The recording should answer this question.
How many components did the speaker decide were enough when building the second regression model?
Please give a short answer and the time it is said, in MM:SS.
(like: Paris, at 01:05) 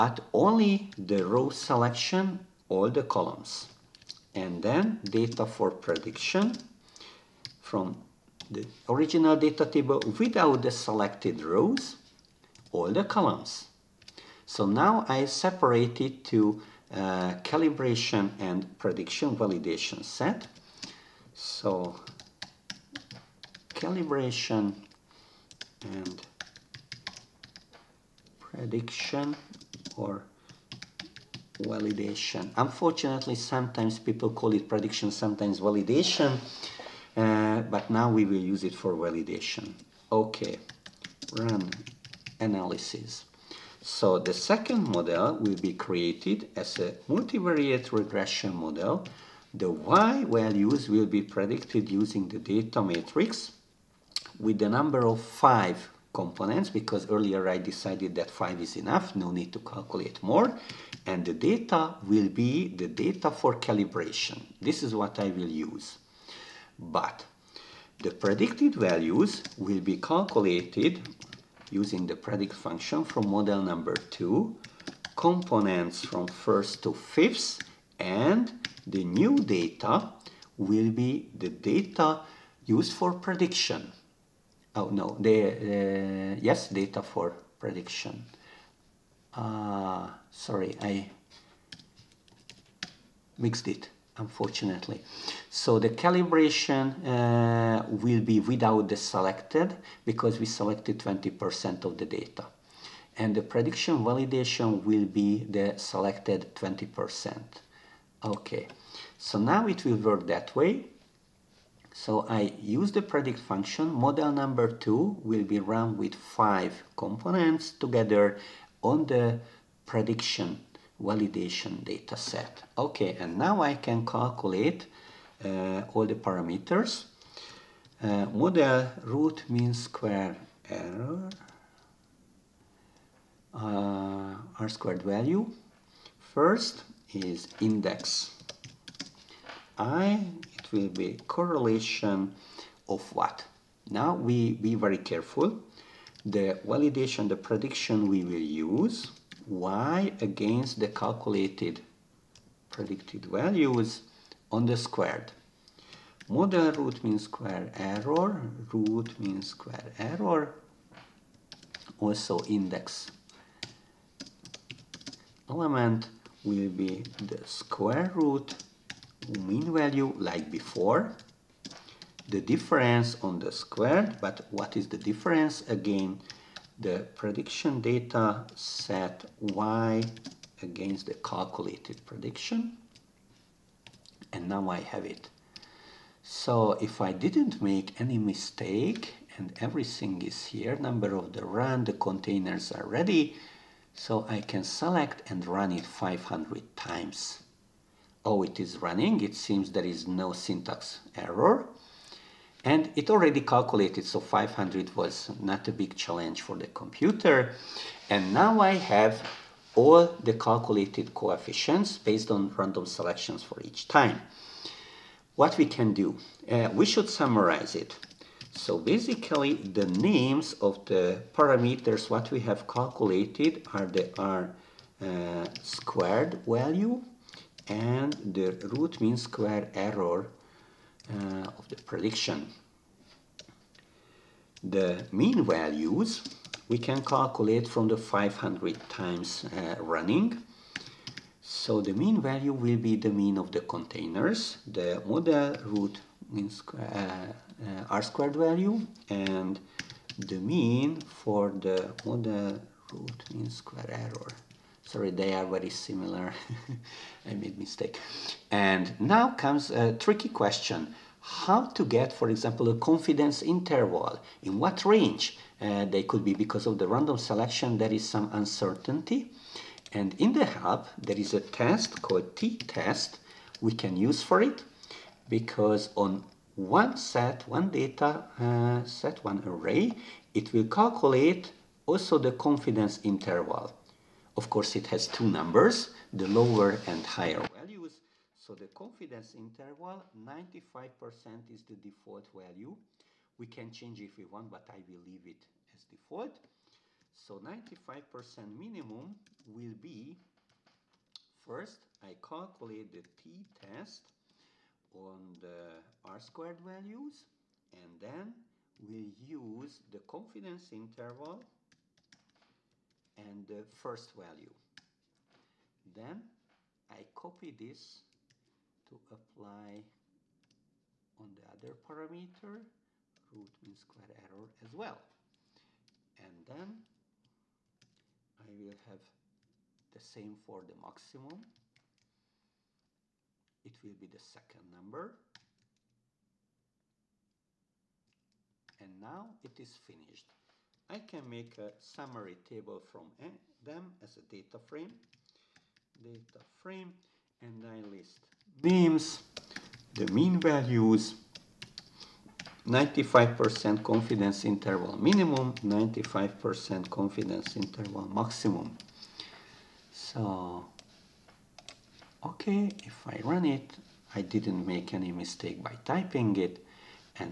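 5, at 00:54.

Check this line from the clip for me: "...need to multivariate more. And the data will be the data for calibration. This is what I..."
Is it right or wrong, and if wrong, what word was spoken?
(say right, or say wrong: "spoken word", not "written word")
wrong: "calculate", not "multivariate".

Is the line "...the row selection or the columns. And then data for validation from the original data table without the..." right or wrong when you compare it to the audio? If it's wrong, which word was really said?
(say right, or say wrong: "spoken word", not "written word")
wrong: "prediction", not "validation".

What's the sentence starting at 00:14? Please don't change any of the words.
So now I separate it to uh, calibration and prediction validation set.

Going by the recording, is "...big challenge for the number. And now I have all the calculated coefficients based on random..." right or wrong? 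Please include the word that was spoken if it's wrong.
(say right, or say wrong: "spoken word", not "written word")
wrong: "computer", not "number".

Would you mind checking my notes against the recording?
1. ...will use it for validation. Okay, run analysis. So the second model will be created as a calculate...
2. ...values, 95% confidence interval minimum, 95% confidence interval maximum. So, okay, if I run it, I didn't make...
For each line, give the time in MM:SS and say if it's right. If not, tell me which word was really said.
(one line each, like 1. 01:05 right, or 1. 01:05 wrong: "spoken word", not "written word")
1. 00:38 wrong: "multivariate", not "calculate"
2. 05:50 right.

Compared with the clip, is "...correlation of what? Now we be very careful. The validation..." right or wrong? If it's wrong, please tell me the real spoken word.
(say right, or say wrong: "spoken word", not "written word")
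right.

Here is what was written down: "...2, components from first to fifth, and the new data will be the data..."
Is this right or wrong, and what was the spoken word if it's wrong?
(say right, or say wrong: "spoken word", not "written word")
right.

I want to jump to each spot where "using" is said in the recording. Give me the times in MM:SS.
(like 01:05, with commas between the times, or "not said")
00:51, 01:11.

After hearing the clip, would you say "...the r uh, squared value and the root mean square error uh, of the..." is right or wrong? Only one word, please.
right.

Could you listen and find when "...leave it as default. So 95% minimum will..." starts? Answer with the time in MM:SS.
04:55.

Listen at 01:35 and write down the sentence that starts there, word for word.
So the calibration uh, will be without the selected because we selected 20% of the data.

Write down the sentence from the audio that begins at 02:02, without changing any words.
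Okay, and now I can calculate uh, all the parameters.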